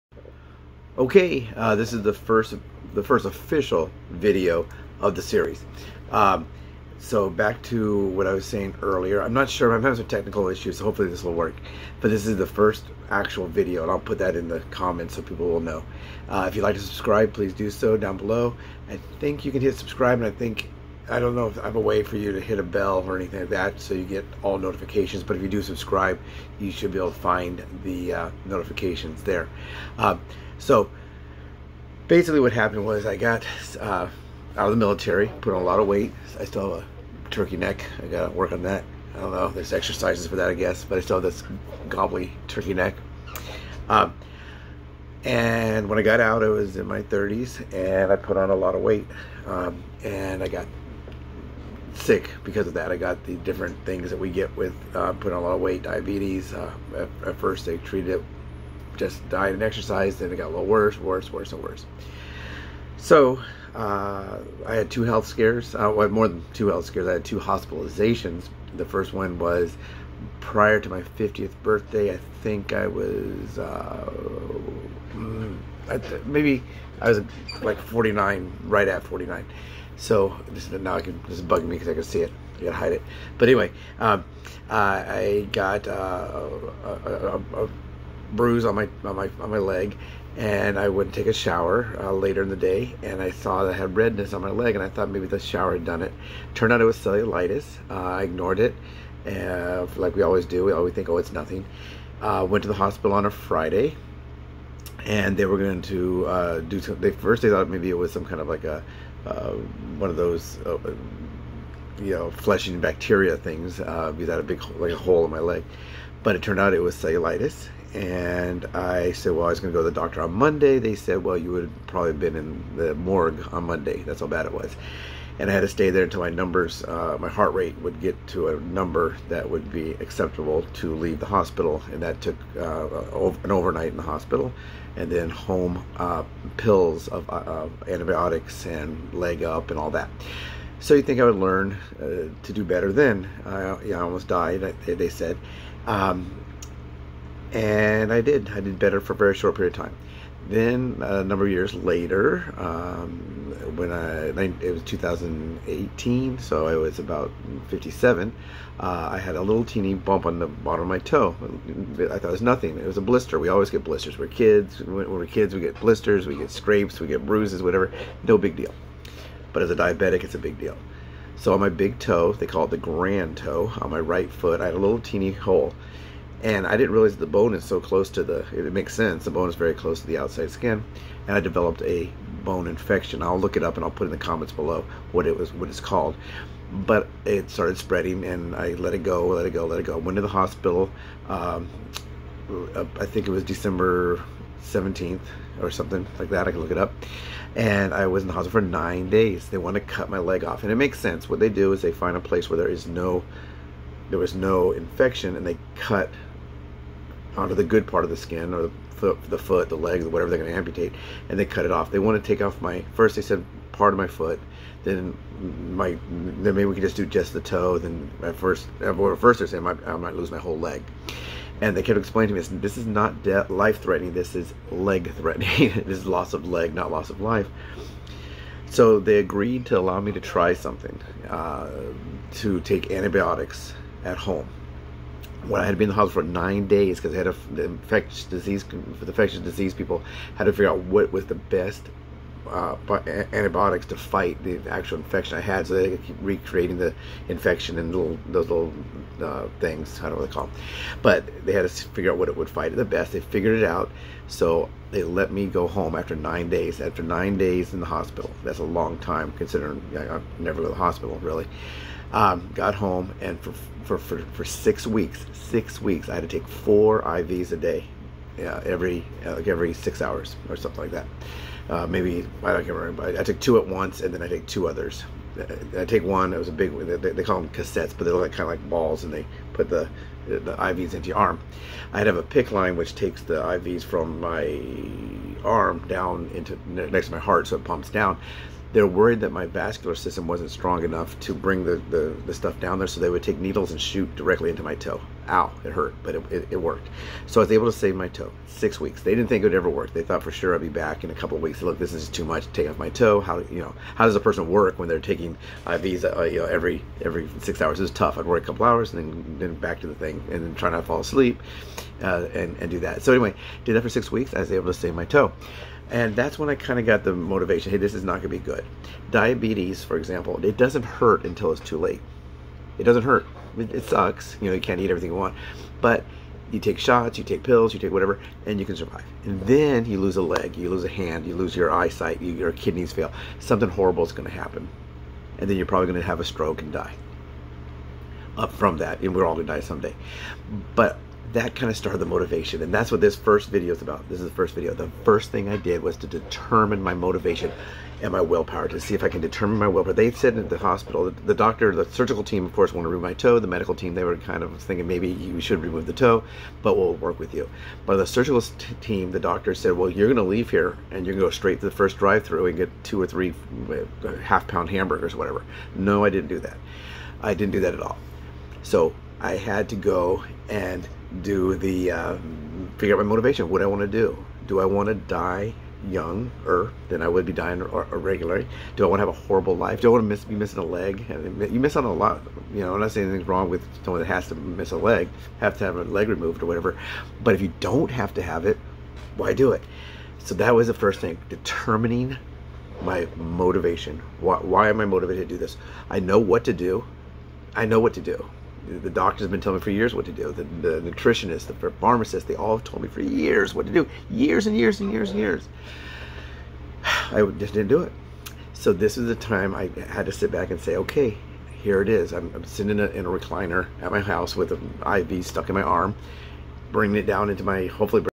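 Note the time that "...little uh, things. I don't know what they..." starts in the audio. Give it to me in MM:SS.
04:08.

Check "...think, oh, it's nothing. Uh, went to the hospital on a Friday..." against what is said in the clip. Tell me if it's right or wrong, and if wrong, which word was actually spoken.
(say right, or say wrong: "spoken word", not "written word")
right.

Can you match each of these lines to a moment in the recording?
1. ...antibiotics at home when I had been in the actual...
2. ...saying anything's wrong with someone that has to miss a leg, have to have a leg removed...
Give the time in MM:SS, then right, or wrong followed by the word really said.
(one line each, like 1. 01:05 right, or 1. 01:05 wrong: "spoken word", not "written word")
1. 03:52 wrong: "hospital", not "actual"
2. 06:22 right.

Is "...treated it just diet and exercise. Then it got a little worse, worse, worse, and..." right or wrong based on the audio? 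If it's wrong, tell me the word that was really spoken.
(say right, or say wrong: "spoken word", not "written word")
right.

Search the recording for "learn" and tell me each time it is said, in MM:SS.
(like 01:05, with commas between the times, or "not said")
02:21.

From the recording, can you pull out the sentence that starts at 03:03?
I'll look it up and I'll put in the comments below what it was, what it's called.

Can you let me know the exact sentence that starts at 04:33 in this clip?
I, I, took two at once, and then I take two others.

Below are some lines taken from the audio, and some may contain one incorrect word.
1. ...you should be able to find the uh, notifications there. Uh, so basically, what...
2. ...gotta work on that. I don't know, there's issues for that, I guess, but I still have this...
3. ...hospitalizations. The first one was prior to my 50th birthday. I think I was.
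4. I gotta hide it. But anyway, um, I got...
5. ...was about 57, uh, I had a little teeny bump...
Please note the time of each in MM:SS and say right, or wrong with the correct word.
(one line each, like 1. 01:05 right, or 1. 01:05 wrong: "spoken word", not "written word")
1. 00:26 right
2. 00:38 wrong: "exercises", not "issues"
3. 01:07 right
4. 01:22 right
5. 02:36 right.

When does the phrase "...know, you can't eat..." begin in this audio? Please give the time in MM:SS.
05:24.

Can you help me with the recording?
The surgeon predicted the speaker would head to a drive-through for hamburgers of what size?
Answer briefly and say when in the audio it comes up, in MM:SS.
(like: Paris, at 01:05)
half pound, at 06:04.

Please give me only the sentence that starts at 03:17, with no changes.
And I was in the hospital for nine days.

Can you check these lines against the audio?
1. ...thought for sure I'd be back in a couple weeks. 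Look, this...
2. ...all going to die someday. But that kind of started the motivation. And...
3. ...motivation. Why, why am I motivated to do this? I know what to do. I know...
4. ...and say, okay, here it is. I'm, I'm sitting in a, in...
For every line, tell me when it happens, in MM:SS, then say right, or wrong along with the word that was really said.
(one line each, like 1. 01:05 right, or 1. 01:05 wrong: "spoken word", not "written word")
1. 05:00 right
2. 05:39 right
3. 06:33 right
4. 06:50 right.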